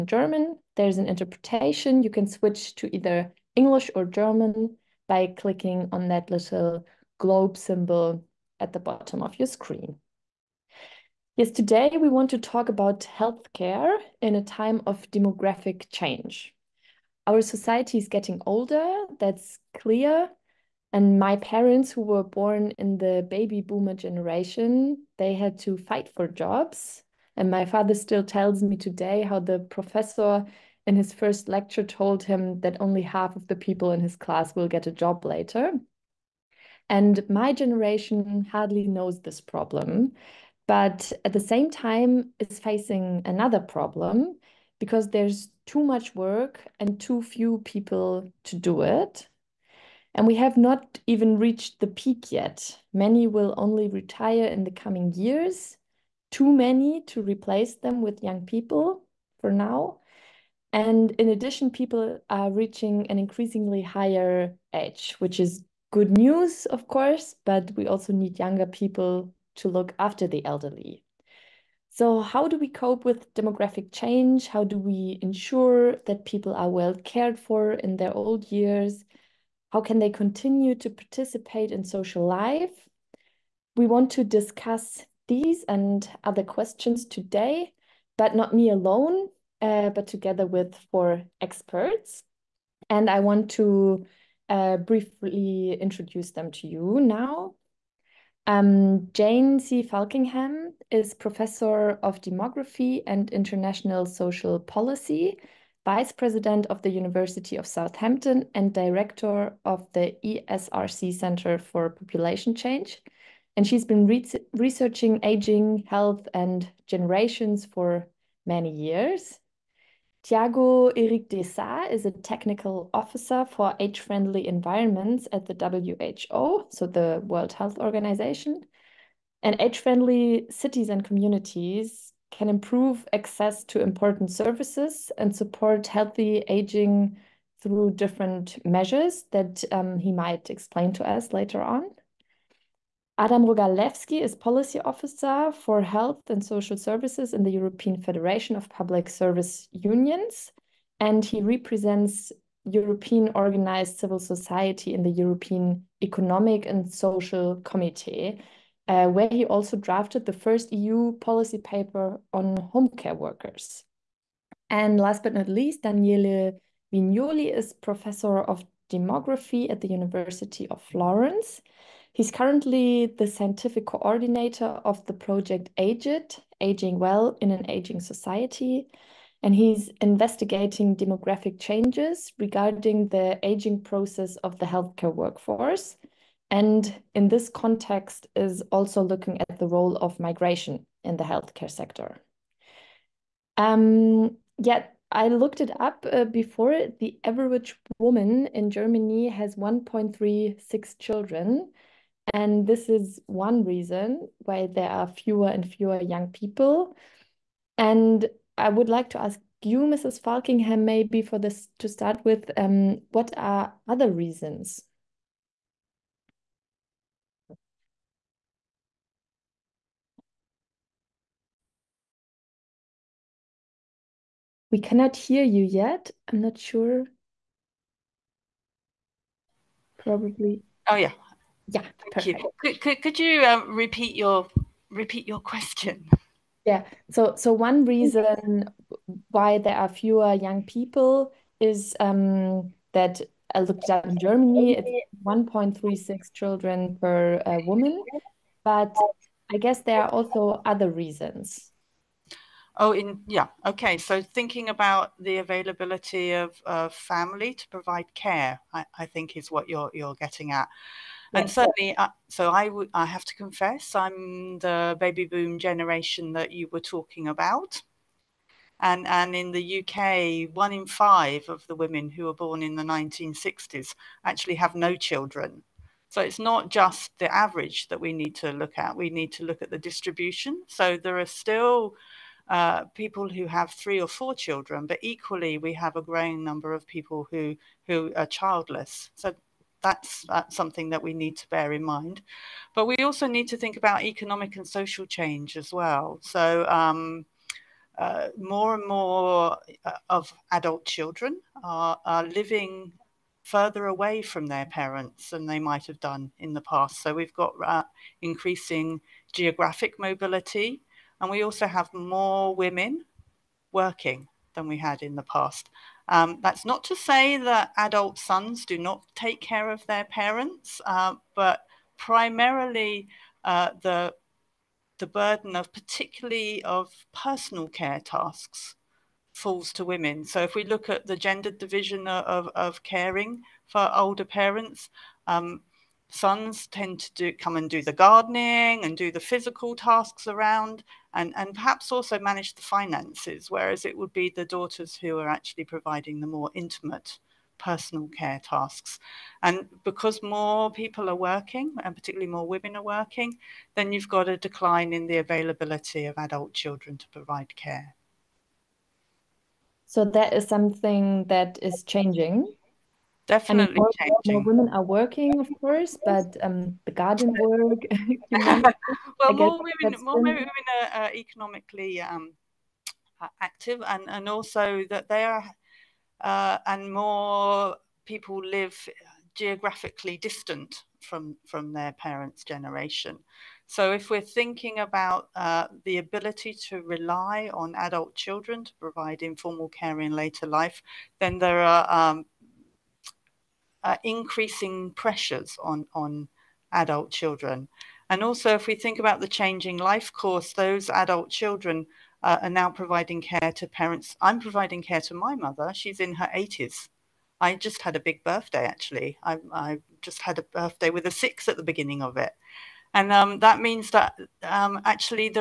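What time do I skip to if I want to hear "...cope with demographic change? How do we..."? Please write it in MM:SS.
01:12.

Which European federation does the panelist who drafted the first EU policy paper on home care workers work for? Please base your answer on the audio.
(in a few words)
European Federation of Public Service Unions.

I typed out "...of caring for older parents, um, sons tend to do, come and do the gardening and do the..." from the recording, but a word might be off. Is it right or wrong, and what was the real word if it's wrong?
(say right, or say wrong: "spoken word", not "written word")
right.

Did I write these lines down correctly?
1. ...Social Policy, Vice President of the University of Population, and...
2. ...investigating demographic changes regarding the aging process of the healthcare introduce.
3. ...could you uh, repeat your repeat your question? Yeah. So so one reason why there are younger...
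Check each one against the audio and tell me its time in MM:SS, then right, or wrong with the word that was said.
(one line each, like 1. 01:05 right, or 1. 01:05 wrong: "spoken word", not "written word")
1. 01:44 wrong: "Southampton", not "Population"
2. 03:00 wrong: "workforce", not "introduce"
3. 03:53 wrong: "fewer", not "younger".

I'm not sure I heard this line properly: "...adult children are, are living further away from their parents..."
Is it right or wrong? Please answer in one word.
right.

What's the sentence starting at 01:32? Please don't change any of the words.
And I want to uh, briefly introduce them to you now.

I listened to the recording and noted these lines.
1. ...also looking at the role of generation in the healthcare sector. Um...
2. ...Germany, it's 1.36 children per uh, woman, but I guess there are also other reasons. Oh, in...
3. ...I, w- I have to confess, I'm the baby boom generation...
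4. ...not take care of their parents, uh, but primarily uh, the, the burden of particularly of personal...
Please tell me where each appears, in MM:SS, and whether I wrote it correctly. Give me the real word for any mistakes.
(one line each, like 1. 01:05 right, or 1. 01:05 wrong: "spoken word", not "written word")
1. 03:08 wrong: "migration", not "generation"
2. 04:04 right
3. 04:22 right
4. 05:18 right.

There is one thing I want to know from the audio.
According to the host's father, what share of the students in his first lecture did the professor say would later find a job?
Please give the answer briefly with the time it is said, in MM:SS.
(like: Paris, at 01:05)
half, at 00:32.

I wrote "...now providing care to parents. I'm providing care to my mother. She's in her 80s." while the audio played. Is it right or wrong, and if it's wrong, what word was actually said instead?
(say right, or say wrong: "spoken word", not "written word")
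right.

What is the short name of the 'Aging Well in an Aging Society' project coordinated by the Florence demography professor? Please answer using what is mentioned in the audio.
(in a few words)
Age-It.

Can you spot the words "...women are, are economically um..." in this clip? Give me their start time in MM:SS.
06:10.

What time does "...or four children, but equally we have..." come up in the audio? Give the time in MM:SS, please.
04:44.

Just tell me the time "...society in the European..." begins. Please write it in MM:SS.
02:34.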